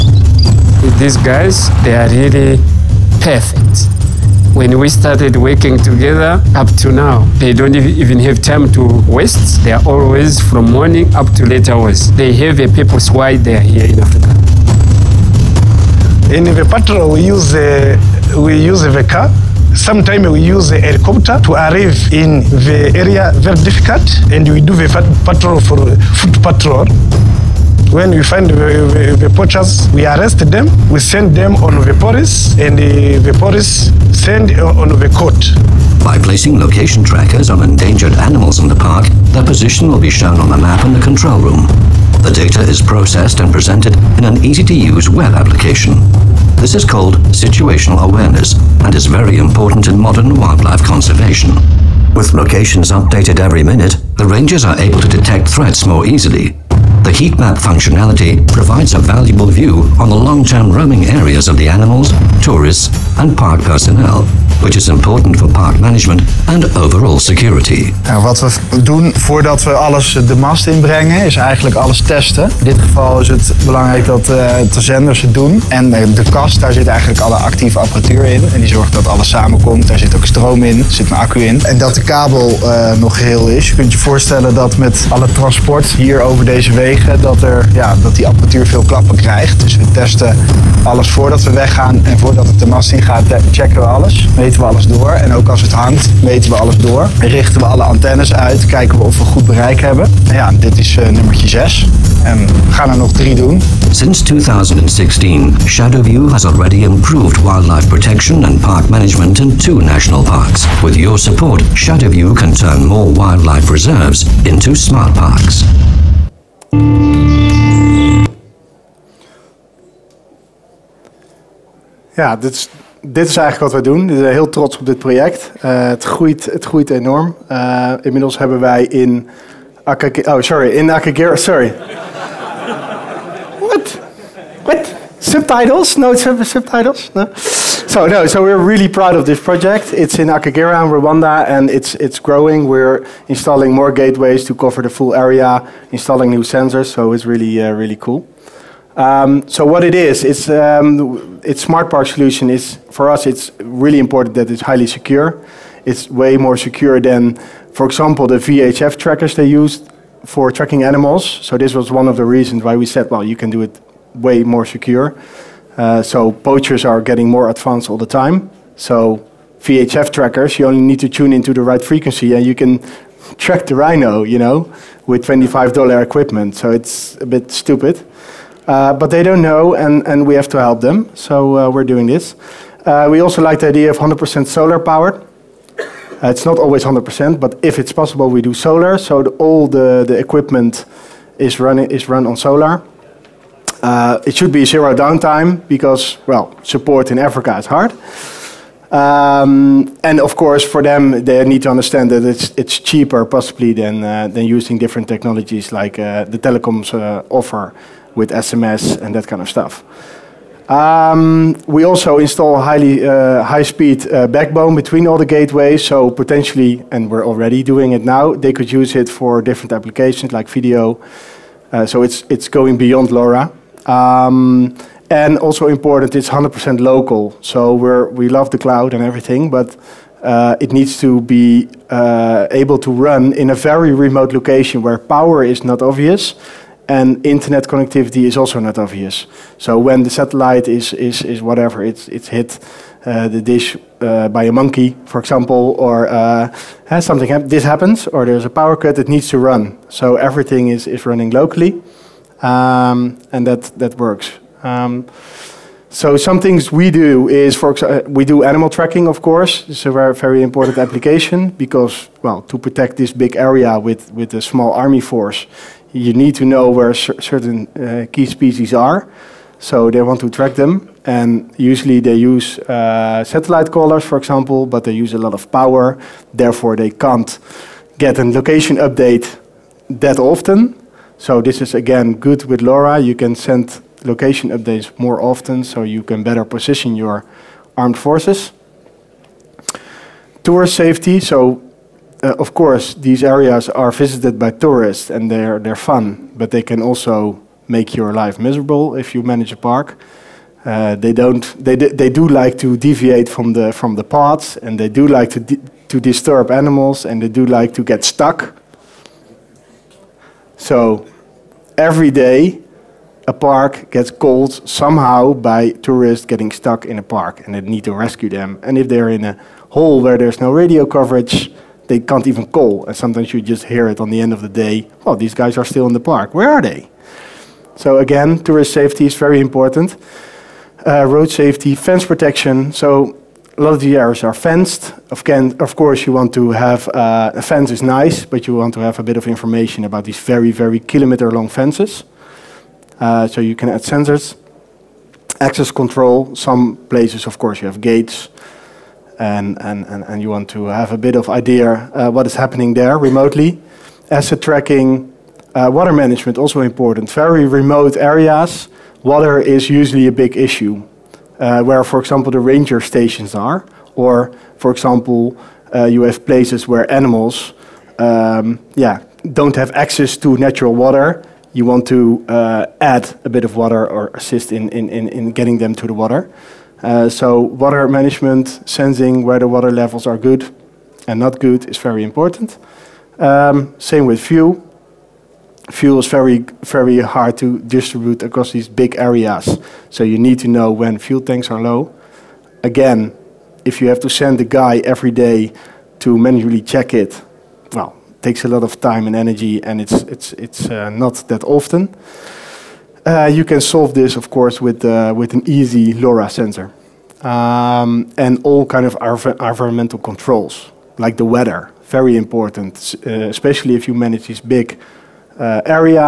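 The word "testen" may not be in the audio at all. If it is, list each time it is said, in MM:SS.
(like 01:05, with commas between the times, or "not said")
01:12, 01:29.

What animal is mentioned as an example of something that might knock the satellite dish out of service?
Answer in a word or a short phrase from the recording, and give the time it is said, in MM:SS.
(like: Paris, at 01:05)
a monkey, at 04:04.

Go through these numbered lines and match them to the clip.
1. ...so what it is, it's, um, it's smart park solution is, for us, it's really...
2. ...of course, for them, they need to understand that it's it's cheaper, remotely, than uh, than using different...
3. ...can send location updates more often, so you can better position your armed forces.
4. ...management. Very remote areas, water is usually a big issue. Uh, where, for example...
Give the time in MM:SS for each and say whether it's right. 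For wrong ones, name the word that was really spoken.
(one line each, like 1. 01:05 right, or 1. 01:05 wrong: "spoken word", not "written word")
1. 02:29 right
2. 03:20 wrong: "possibly", not "remotely"
3. 04:43 right
4. 05:56 wrong: "important", not "management".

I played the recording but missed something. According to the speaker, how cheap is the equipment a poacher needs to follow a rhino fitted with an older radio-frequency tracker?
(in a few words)
$25.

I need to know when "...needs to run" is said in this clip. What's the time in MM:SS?
04:09.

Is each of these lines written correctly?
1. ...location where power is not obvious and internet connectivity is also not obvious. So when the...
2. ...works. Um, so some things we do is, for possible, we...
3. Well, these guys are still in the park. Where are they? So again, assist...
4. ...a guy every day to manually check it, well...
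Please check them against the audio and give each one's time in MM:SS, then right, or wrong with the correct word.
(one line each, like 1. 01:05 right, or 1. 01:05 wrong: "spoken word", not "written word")
1. 03:54 right
2. 04:13 wrong: "example", not "possible"
3. 05:25 wrong: "tourist", not "assist"
4. 06:34 right.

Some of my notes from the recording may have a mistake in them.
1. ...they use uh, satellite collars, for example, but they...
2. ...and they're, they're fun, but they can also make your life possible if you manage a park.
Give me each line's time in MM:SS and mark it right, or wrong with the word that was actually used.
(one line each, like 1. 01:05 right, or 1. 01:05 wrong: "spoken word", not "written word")
1. 04:32 right
2. 04:55 wrong: "miserable", not "possible".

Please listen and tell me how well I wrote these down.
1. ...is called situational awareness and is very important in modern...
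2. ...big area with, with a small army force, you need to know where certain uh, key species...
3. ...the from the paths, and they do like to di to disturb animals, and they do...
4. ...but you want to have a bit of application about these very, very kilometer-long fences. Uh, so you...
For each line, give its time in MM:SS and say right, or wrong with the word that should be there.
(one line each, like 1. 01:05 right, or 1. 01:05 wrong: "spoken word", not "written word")
1. 00:46 right
2. 04:23 right
3. 05:03 right
4. 05:38 wrong: "information", not "application".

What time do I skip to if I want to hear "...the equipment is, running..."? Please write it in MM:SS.
03:10.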